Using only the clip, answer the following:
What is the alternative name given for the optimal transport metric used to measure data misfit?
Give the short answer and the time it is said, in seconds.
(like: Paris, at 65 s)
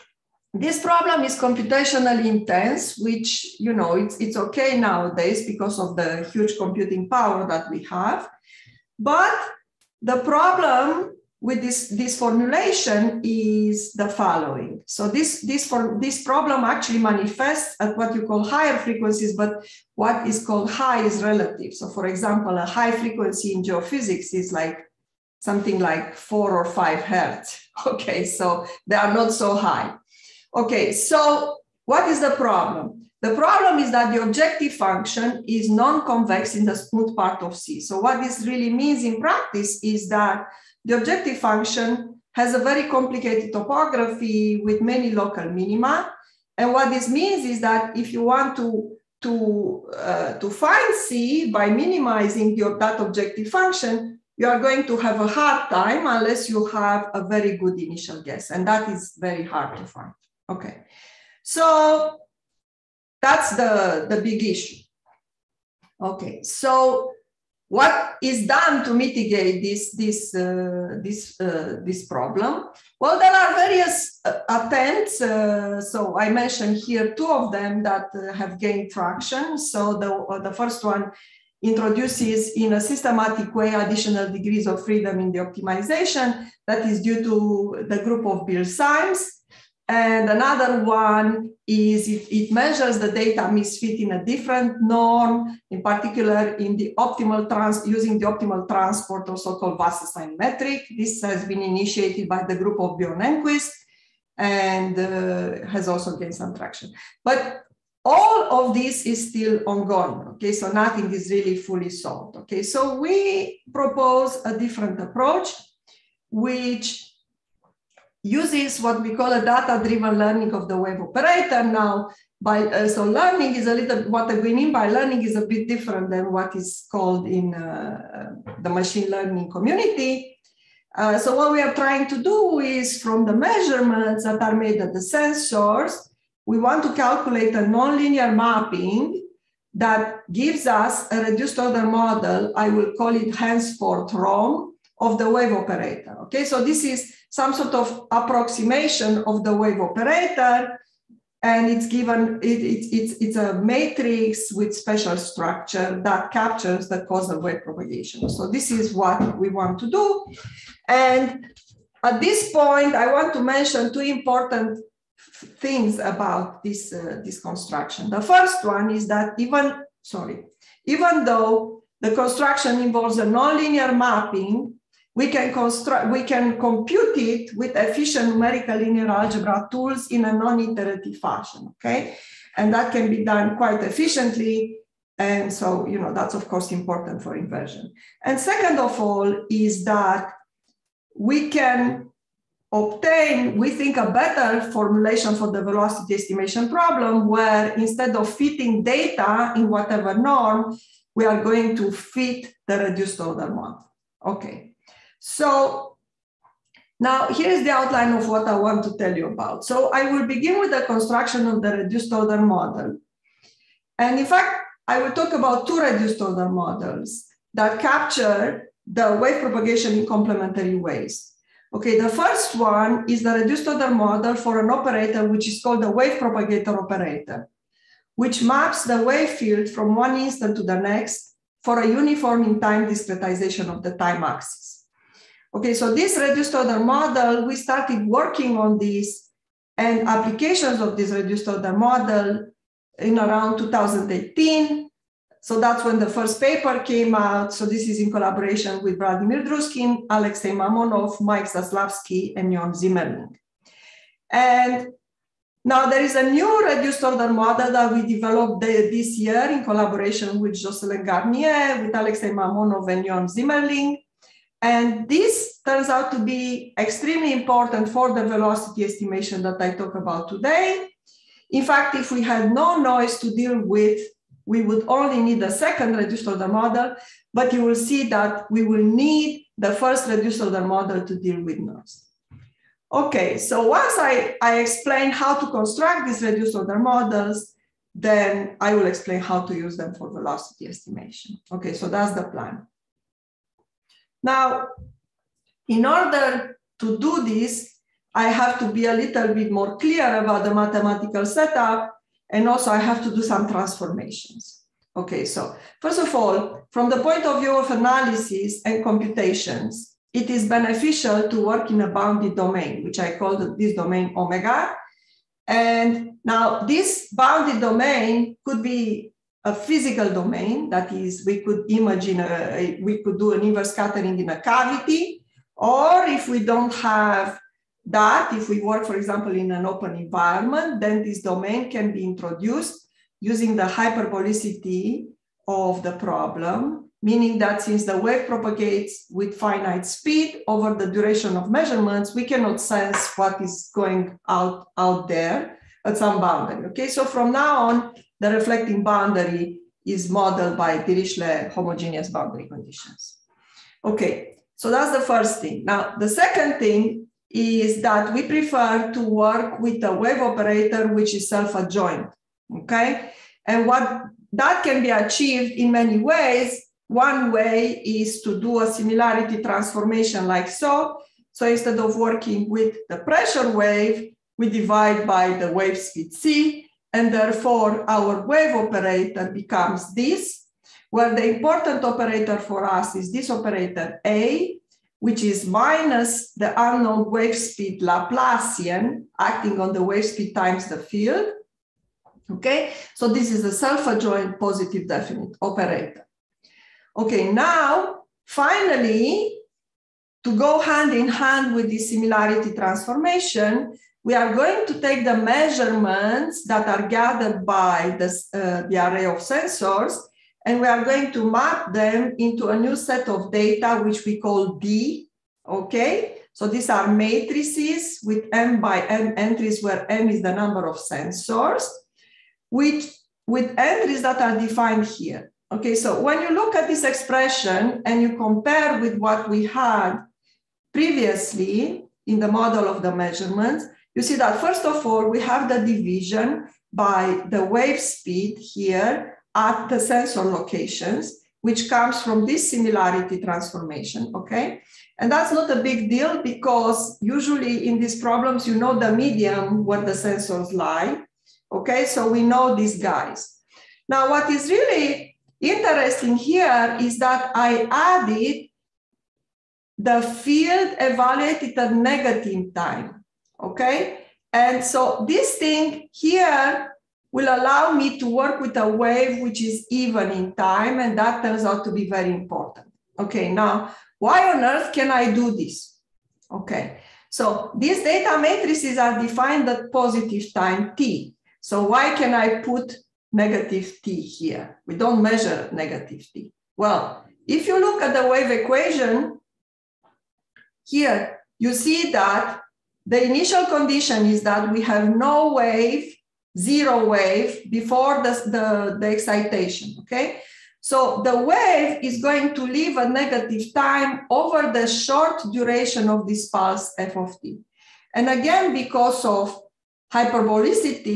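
Wasserstein metric, at 99 s.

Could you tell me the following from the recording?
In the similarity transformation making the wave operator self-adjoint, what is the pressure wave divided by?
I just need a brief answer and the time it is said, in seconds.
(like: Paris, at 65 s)
the wave speed c, at 375 s.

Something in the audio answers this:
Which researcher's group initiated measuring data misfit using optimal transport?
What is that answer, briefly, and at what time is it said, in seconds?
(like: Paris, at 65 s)
Bjorn Engquist, at 102 s.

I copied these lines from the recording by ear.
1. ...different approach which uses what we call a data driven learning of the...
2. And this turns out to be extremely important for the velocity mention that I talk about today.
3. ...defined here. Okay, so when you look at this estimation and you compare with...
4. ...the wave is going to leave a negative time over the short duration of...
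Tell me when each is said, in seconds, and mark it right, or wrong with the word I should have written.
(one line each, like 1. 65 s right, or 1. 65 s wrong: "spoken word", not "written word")
1. 114 s right
2. 264 s wrong: "estimation", not "mention"
3. 424 s wrong: "expression", not "estimation"
4. 501 s right.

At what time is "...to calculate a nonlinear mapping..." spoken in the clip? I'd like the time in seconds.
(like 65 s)
136 s.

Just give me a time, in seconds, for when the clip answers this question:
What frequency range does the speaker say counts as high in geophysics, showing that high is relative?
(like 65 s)
26 s.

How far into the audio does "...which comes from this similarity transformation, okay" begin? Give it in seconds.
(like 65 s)
441 s.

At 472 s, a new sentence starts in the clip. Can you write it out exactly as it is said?
Okay, now, why on earth can I do this?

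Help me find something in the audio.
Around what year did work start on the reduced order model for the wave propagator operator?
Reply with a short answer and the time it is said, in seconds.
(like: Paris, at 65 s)
2018, at 243 s.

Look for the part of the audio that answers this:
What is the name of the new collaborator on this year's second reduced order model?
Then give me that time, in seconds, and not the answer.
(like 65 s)
260 s.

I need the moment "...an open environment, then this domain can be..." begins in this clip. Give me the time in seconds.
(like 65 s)
329 s.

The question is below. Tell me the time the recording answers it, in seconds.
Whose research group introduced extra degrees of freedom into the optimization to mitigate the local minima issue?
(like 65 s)
88 s.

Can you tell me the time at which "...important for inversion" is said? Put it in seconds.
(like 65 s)
186 s.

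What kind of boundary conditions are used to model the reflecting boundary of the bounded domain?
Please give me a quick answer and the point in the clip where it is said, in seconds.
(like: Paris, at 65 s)
Dirichlet homogeneous, at 350 s.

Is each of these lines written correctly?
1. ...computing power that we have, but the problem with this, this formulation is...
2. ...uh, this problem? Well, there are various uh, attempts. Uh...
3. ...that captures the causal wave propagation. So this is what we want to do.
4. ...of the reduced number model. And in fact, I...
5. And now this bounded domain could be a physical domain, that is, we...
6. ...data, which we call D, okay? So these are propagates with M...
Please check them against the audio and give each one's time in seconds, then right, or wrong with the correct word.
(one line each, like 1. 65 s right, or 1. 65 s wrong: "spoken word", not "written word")
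1. 6 s right
2. 71 s right
3. 156 s right
4. 211 s wrong: "order", not "number"
5. 315 s right
6. 413 s wrong: "matrices", not "propagates".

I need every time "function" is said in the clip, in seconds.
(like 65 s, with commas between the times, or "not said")
34 s, 41 s, 53 s.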